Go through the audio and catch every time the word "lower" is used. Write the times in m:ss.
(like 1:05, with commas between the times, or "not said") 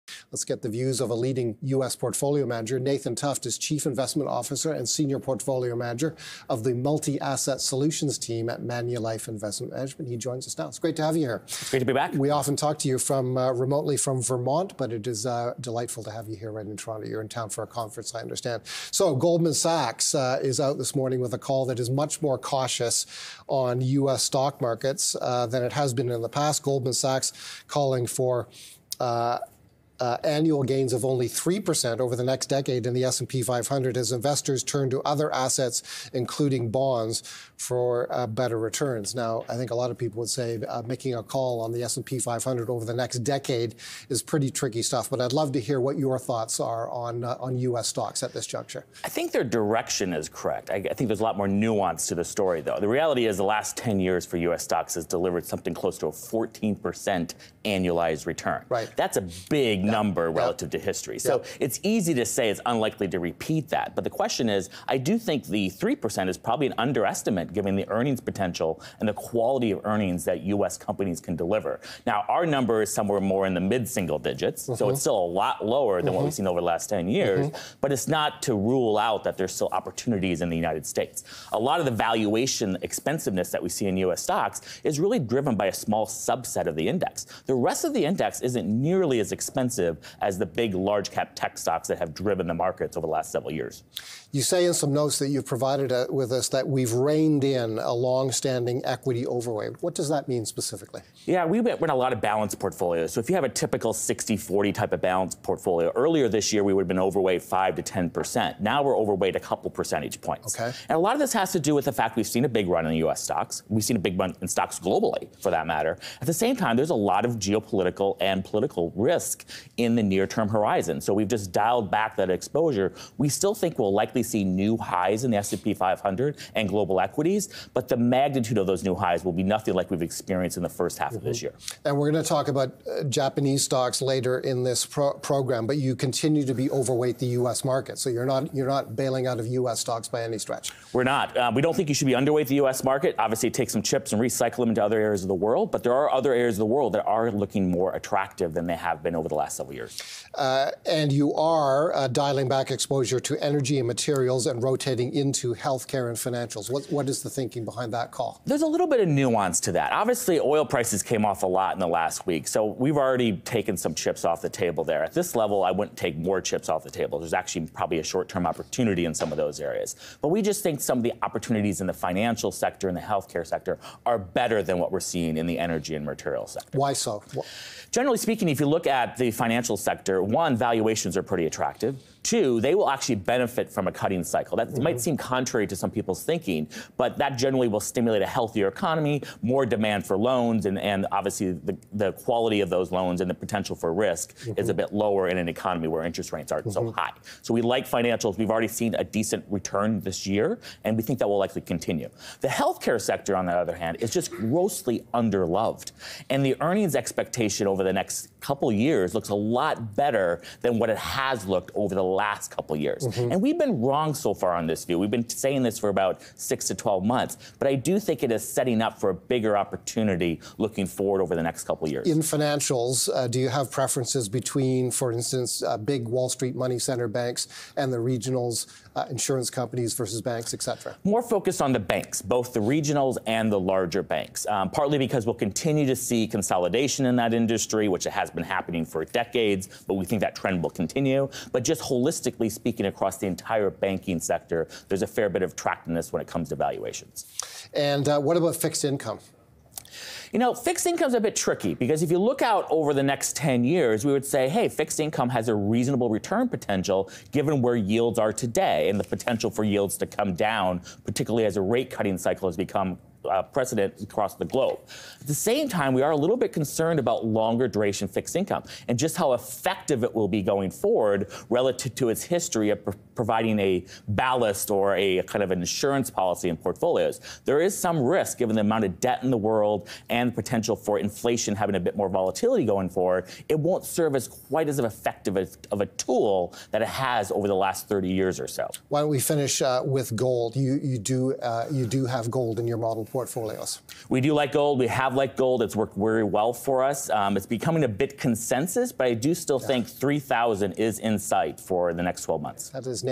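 1:15, 3:14.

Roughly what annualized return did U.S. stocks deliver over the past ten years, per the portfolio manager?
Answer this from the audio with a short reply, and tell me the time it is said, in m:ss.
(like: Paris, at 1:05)
14%, at 0:56.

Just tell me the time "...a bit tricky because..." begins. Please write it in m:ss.
4:11.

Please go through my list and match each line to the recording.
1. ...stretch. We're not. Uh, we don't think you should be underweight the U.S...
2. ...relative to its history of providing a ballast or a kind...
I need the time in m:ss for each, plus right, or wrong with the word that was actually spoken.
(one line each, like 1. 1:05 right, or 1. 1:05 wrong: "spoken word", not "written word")
1. 2:20 right
2. 4:31 right.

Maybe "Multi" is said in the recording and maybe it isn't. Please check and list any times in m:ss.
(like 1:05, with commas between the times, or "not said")
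0:06.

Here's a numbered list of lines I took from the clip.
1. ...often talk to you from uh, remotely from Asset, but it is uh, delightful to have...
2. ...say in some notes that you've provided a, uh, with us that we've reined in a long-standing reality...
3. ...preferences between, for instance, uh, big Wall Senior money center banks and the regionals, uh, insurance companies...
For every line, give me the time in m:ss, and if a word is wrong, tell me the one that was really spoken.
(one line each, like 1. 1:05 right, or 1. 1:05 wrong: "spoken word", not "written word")
1. 0:12 wrong: "Vermont", not "Asset"
2. 1:34 wrong: "equity", not "reality"
3. 3:43 wrong: "Street", not "Senior".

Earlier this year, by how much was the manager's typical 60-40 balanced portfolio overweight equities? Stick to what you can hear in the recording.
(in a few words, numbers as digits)
5 to 10%.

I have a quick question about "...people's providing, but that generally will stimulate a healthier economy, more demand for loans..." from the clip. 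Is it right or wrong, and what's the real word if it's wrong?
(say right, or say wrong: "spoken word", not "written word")
wrong: "thinking", not "providing".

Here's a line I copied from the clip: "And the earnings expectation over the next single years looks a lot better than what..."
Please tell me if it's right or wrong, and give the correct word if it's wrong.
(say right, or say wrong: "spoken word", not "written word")
wrong: "couple", not "single".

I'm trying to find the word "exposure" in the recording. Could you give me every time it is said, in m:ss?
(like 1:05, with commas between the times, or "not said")
2:02, 2:32.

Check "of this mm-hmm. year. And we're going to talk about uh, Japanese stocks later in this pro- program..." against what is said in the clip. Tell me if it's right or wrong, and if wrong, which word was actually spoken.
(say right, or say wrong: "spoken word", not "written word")
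right.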